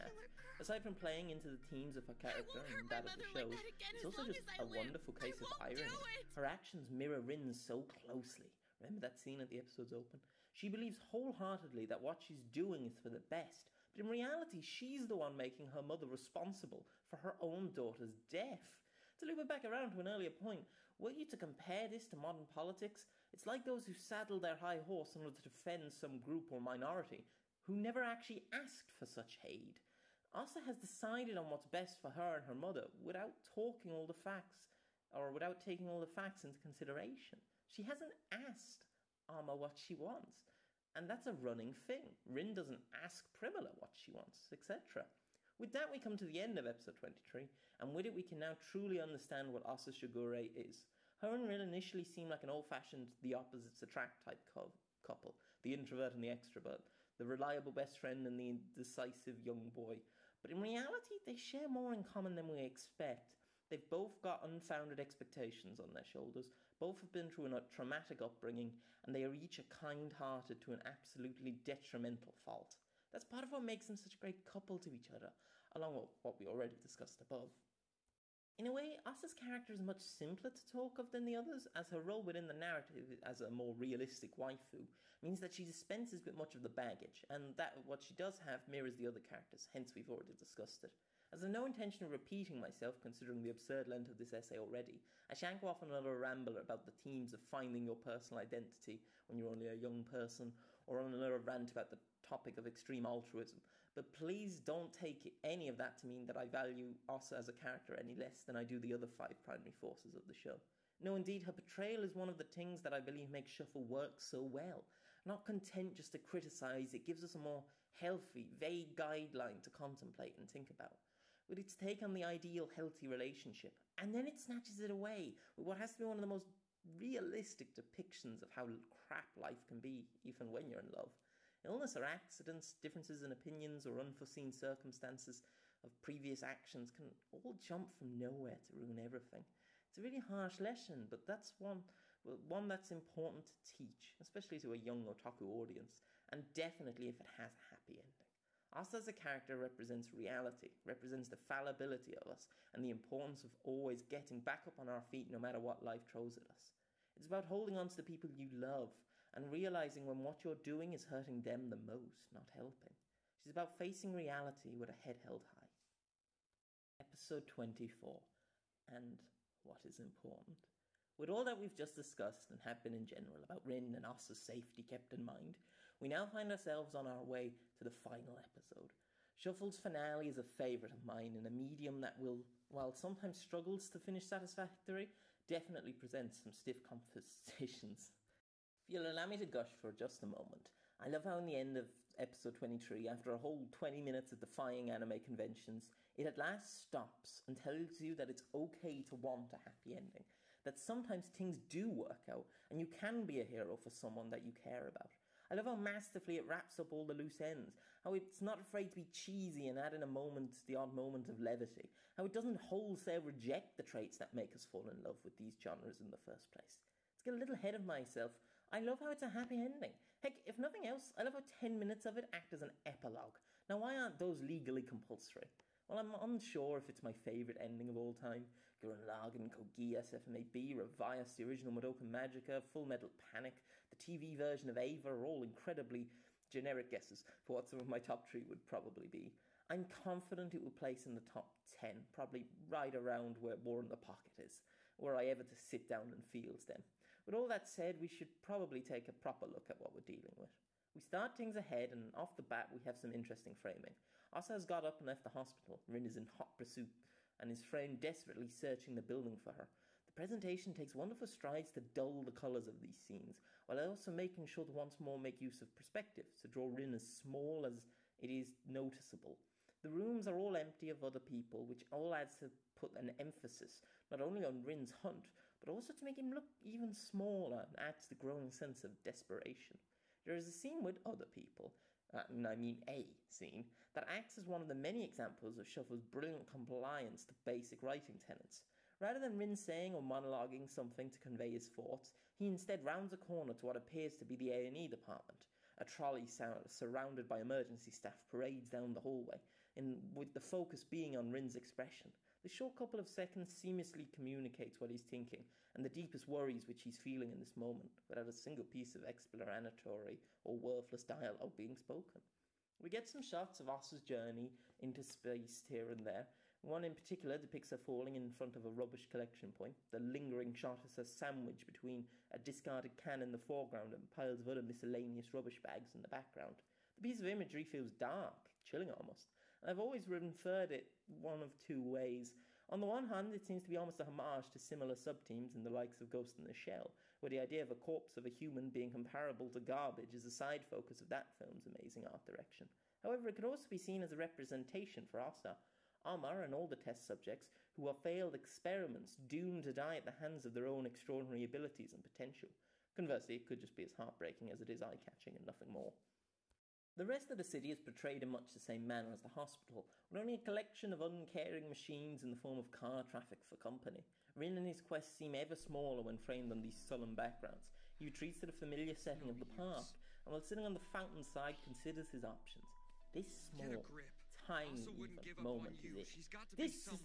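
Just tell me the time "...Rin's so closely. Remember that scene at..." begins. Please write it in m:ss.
0:07.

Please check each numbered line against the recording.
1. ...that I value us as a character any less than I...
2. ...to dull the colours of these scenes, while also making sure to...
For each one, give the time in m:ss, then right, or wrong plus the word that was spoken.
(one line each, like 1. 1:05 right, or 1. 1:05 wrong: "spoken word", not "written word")
1. 1:46 right
2. 4:21 right.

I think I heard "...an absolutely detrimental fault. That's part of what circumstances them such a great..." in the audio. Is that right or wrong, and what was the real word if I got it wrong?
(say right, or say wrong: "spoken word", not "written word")
wrong: "makes", not "circumstances".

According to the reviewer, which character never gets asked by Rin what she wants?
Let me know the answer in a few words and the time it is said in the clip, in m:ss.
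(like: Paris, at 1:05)
Primula, at 0:43.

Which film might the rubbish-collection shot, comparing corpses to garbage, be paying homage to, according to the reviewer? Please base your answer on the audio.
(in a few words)
Ghost in the Shell.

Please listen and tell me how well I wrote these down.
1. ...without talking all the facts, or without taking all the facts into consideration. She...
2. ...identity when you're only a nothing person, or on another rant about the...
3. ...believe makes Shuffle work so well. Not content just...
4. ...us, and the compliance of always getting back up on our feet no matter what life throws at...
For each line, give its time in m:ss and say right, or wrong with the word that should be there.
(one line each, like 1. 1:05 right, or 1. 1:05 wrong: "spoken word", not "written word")
1. 0:32 right
2. 1:38 wrong: "young", not "nothing"
3. 1:52 right
4. 2:32 wrong: "importance", not "compliance".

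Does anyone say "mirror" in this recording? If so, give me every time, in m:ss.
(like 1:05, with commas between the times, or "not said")
0:06, 1:28.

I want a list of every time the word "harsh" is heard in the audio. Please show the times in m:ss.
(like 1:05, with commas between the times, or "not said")
2:20.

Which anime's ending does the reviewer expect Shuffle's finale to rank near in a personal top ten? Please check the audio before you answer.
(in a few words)
War in the Pocket.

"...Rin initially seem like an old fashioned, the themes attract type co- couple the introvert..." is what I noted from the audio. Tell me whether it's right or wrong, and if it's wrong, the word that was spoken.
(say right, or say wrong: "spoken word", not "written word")
wrong: "opposites", not "themes".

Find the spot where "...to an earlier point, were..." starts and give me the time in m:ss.
0:19.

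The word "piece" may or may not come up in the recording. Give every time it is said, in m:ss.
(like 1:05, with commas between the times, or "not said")
5:08, 5:27.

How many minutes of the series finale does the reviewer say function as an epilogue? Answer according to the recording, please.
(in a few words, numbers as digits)
10.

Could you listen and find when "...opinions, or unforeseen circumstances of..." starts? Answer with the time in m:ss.
2:13.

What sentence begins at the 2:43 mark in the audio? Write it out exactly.
It's about facing reality with a head held high.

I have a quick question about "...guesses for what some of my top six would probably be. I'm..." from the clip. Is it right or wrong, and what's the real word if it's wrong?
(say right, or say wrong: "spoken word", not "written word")
wrong: "three", not "six".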